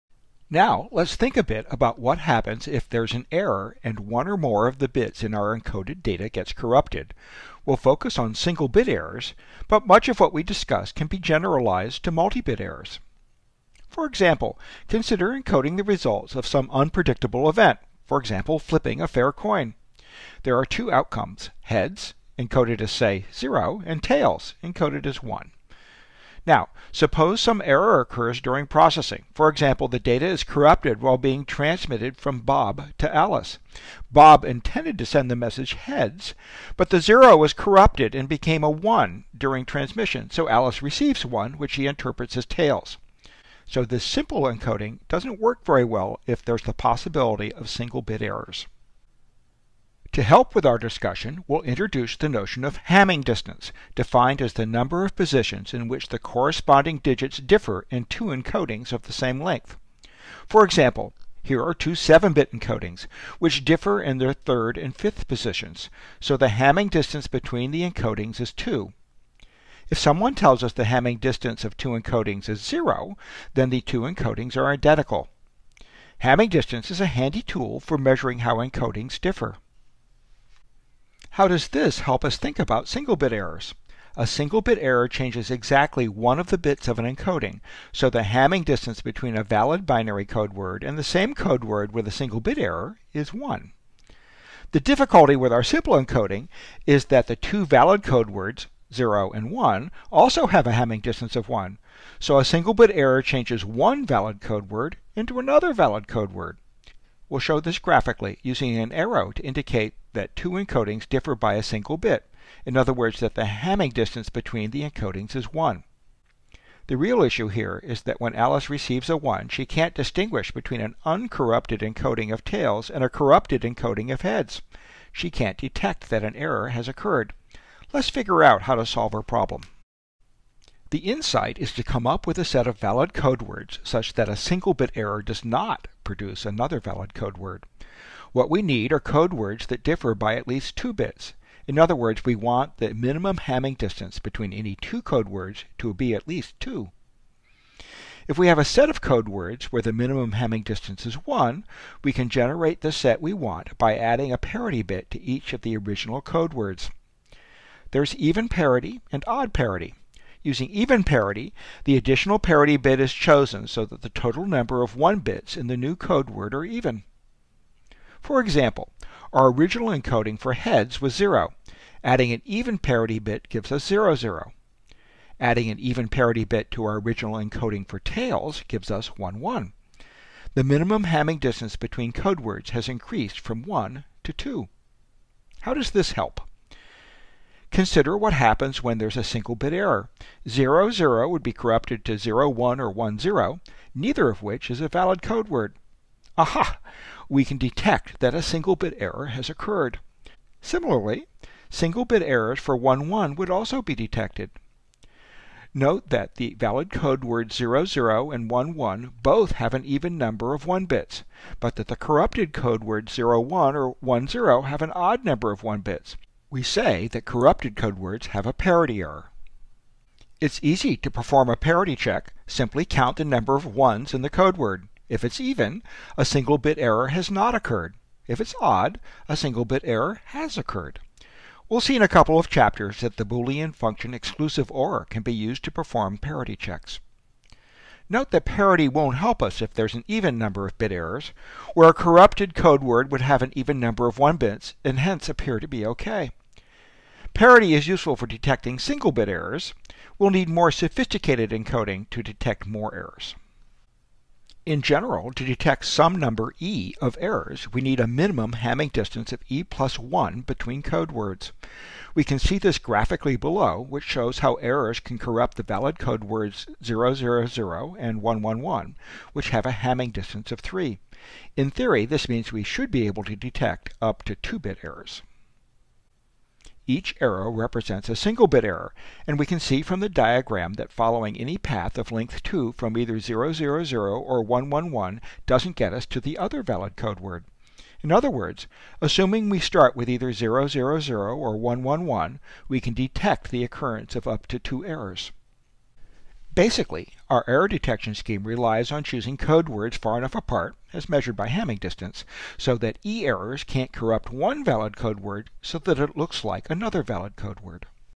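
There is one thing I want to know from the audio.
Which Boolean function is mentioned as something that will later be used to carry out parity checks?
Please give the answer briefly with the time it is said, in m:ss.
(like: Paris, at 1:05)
exclusive OR, at 3:54.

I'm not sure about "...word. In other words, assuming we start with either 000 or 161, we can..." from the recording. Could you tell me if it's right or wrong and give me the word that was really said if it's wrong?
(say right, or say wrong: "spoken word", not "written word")
wrong: "111", not "161".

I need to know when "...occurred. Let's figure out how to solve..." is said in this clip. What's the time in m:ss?
2:06.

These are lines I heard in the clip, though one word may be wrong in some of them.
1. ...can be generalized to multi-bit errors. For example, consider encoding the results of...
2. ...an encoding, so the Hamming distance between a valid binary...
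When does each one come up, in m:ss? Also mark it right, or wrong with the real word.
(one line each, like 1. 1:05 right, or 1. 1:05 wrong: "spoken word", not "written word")
1. 0:10 right
2. 1:26 right.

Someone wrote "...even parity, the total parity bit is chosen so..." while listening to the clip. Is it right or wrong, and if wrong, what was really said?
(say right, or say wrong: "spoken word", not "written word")
wrong: "additional", not "total".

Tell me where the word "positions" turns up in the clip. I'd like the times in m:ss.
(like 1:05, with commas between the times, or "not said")
0:55, 1:05.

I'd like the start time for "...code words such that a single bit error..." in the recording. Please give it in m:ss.
2:13.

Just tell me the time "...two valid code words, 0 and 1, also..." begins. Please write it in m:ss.
1:37.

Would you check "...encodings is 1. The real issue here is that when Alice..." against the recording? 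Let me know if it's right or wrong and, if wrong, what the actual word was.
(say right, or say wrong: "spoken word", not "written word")
right.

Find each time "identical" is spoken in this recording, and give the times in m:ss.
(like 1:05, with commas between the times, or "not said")
1:14.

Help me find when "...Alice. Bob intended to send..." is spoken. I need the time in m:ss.
0:33.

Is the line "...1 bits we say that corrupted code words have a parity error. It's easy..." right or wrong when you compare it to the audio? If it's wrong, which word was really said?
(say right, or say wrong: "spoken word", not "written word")
right.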